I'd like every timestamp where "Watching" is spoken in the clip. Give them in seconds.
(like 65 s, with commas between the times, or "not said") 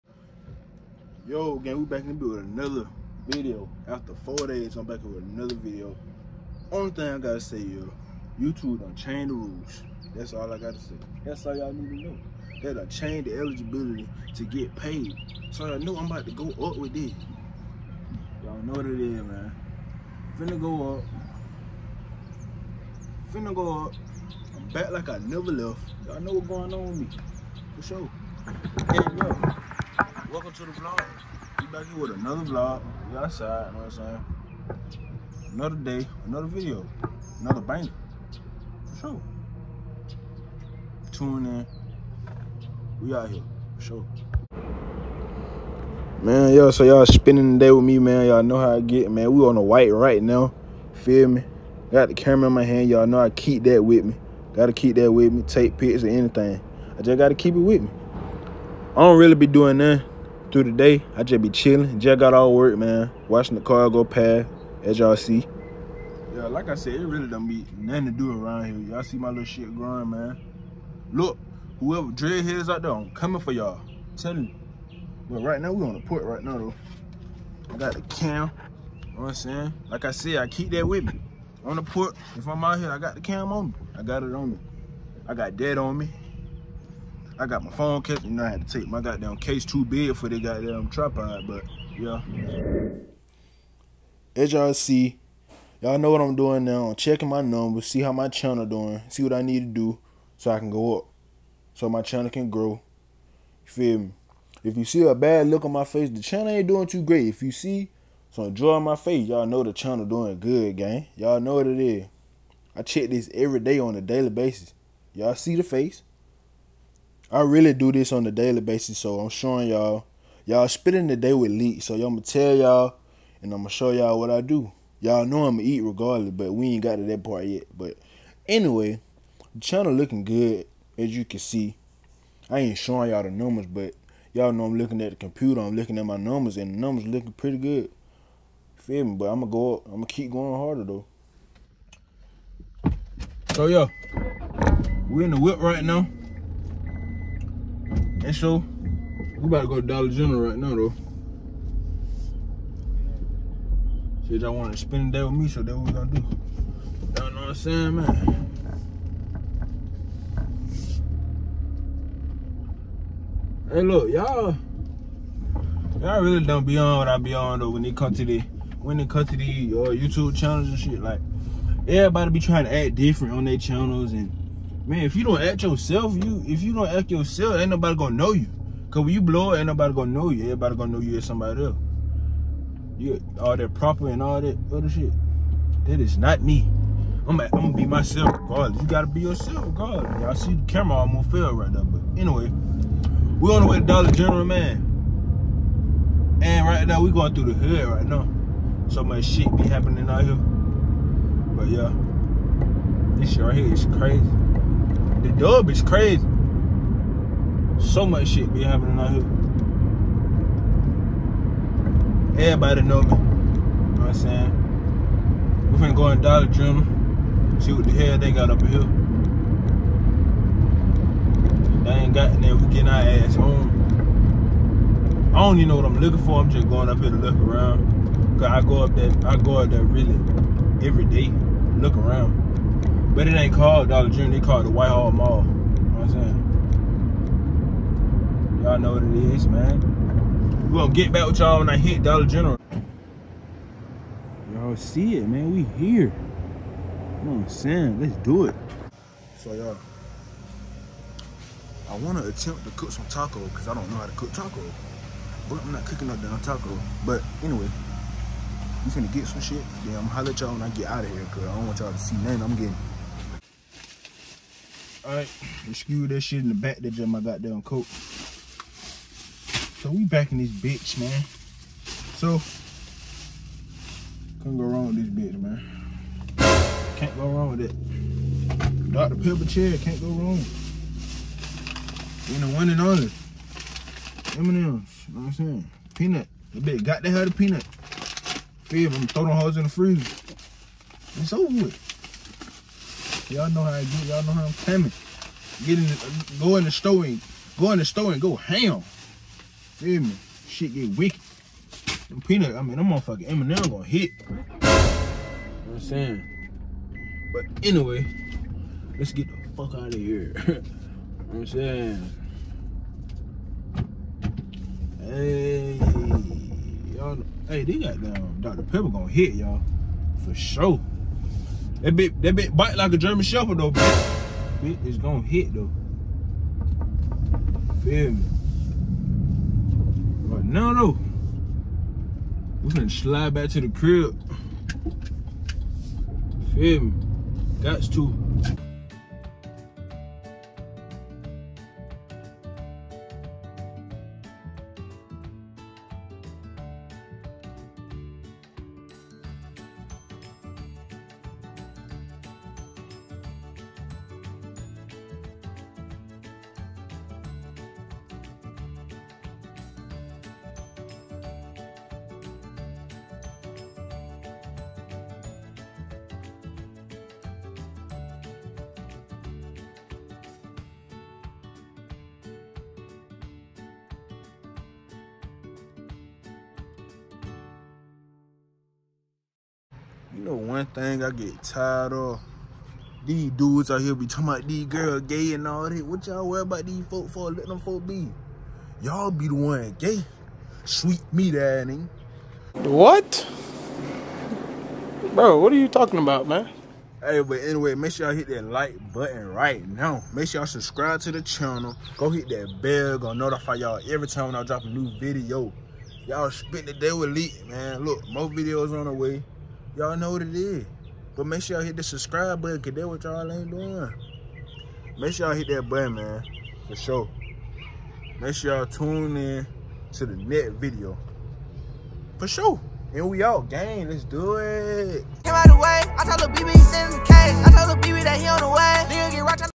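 63 s.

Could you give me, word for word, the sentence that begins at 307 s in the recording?
But anyway, let's get the fuck out of here.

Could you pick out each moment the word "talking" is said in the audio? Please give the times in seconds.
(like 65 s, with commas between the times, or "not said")
384 s, 395 s.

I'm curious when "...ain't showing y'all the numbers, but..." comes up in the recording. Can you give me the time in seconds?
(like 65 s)
132 s.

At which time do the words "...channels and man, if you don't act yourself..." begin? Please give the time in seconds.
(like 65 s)
173 s.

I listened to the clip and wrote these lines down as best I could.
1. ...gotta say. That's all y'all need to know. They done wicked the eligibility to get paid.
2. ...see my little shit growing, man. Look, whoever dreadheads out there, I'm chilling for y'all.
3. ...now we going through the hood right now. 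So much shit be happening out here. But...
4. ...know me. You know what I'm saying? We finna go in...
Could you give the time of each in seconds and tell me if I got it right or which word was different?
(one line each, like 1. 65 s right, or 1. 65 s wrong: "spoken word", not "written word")
1. 10 s wrong: "changed", not "wicked"
2. 69 s wrong: "coming", not "chilling"
3. 196 s right
4. 212 s right.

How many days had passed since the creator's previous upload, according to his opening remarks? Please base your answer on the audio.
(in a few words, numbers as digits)
4.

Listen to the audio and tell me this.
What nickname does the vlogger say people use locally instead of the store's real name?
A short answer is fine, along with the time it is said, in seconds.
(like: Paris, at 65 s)
Whitehall Mall, at 234 s.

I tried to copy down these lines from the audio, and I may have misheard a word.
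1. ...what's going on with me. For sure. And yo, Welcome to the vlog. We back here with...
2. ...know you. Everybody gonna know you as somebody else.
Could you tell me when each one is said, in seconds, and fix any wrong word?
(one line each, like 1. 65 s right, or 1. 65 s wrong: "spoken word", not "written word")
1. 26 s right
2. 180 s right.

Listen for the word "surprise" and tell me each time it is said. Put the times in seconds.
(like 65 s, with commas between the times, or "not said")
not said.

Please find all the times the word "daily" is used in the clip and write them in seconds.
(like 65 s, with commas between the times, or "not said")
114 s, 118 s.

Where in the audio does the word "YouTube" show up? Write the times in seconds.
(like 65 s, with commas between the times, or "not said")
8 s, 169 s.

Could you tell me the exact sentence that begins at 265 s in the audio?
Alright, screw that shit in the back that my goddamn coat.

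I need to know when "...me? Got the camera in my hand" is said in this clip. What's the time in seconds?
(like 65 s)
51 s.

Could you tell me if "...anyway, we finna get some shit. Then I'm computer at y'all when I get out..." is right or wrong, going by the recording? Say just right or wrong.
wrong.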